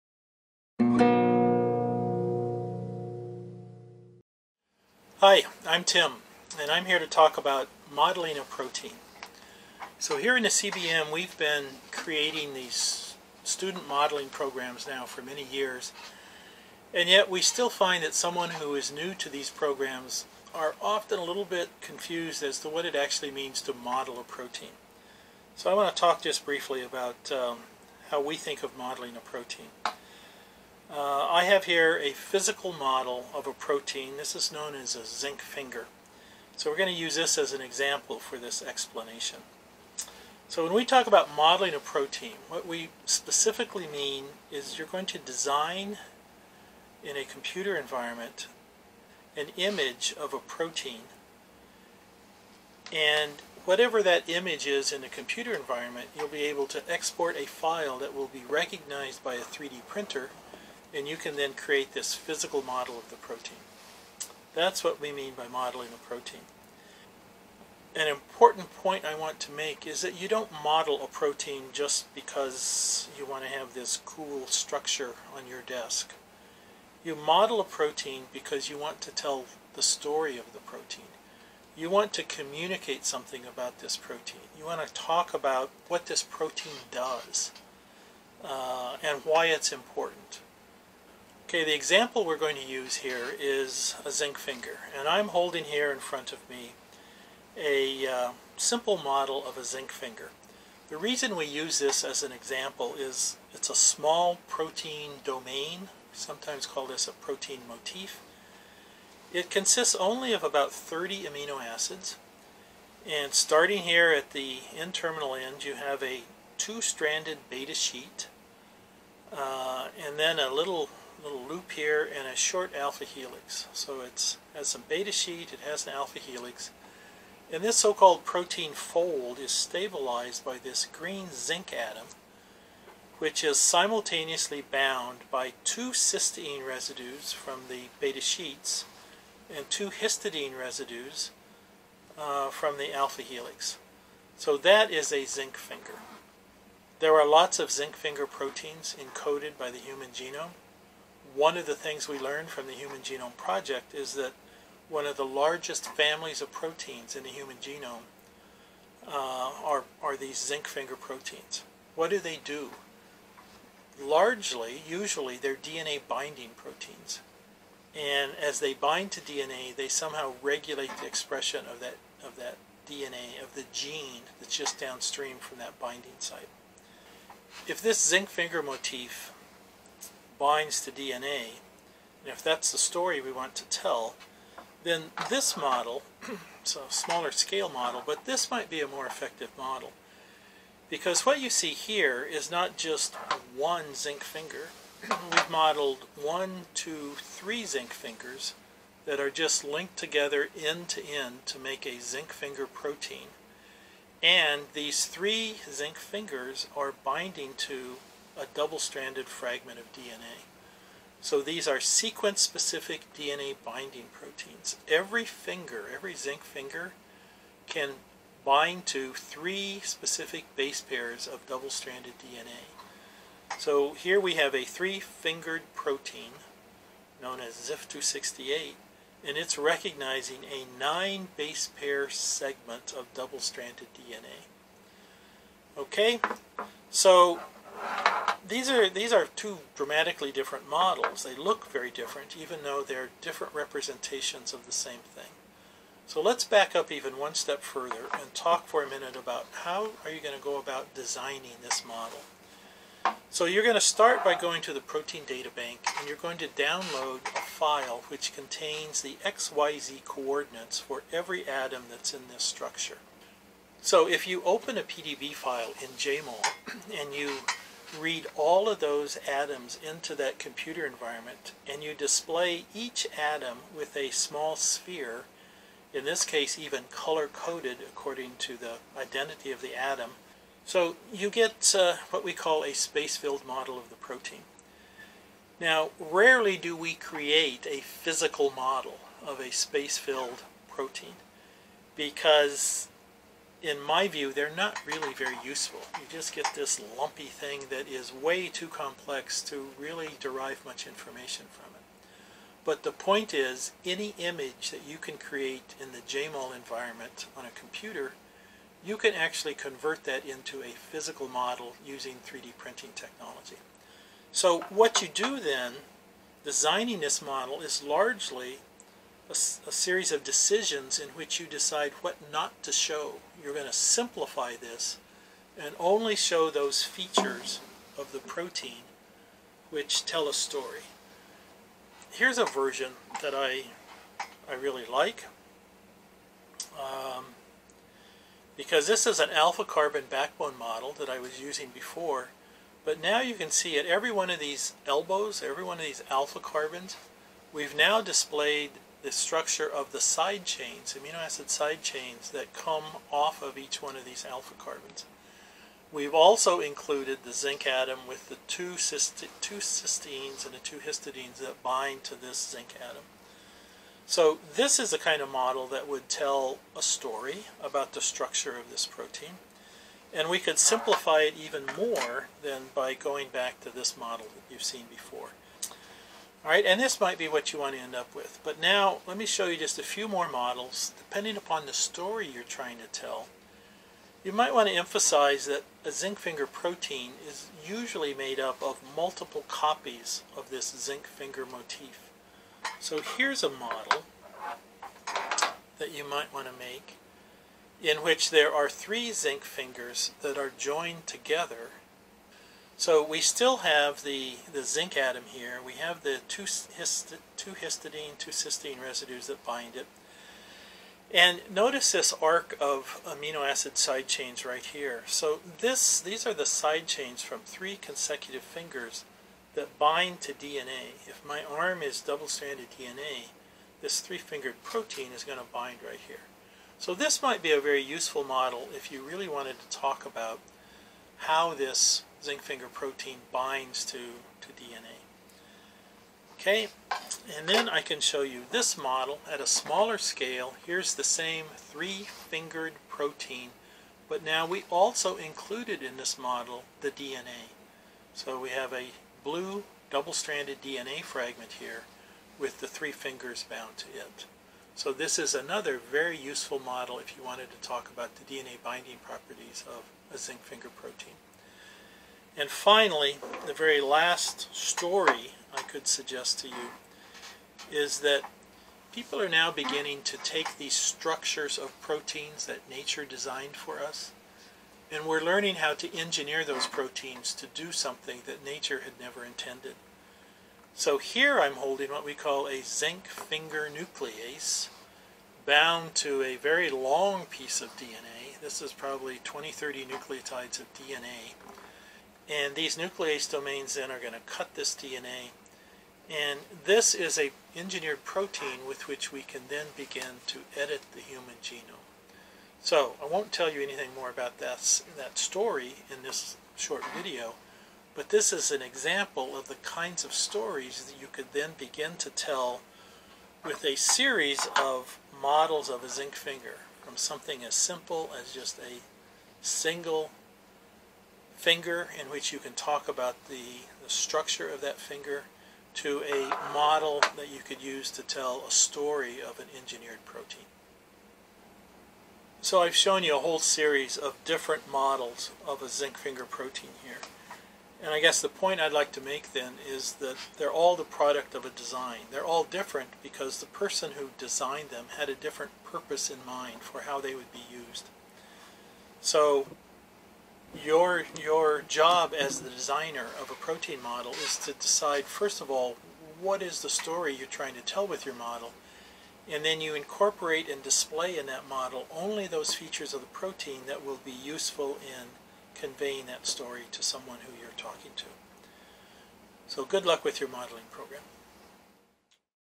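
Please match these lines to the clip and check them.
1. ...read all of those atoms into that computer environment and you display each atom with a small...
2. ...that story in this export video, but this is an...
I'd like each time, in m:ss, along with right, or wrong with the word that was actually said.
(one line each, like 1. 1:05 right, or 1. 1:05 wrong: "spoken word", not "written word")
1. 4:27 right
2. 8:24 wrong: "short", not "export".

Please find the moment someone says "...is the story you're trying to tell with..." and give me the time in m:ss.
9:16.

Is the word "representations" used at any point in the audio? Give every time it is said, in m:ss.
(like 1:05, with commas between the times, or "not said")
4:03.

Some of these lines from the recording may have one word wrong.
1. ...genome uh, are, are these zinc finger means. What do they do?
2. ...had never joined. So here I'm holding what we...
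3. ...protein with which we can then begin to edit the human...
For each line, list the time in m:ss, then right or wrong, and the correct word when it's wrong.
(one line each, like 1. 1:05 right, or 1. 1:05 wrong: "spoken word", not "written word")
1. 2:37 wrong: "proteins", not "means"
2. 7:58 wrong: "intended", not "joined"
3. 8:18 right.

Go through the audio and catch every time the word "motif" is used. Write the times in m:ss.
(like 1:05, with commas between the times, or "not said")
1:47, 2:58, 6:31.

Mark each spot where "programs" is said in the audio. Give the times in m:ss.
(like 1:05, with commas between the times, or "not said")
0:14, 0:19, 9:30.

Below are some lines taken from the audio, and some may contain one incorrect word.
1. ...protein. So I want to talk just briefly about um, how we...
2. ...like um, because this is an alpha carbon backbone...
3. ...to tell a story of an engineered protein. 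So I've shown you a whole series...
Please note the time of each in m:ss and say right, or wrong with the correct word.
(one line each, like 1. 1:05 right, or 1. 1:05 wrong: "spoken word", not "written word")
1. 0:24 right
2. 5:34 right
3. 8:47 right.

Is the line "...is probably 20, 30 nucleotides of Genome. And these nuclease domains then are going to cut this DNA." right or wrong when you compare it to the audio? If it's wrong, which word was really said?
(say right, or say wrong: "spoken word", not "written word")
wrong: "DNA", not "Genome".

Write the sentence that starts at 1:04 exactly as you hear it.
That's what we mean by modeling a protein.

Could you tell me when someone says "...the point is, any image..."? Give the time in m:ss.
5:02.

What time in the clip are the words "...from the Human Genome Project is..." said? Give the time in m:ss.
2:32.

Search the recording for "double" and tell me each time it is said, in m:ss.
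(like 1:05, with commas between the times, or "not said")
3:28, 3:41, 3:53, 7:02, 7:29.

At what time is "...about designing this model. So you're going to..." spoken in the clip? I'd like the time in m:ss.
4:10.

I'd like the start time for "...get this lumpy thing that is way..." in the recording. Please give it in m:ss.
4:56.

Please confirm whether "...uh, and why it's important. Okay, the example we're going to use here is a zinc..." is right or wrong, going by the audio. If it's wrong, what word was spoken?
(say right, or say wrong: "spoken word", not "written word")
right.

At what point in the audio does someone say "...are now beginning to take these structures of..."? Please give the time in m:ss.
7:49.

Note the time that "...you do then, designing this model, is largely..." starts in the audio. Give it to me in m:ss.
5:15.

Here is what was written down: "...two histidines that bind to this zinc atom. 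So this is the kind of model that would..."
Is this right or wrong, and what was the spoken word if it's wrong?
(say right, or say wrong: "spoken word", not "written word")
right.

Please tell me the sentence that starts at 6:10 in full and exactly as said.
And we could simplify it even more than by going back to this model that you've seen before.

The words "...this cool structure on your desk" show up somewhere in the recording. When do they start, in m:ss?
1:13.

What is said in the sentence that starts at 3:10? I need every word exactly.
Because what you see here is not just one zinc finger.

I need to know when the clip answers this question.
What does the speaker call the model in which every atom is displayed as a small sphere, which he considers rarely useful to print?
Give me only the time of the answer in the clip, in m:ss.
4:42.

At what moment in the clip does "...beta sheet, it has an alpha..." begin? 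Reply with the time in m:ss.
2:04.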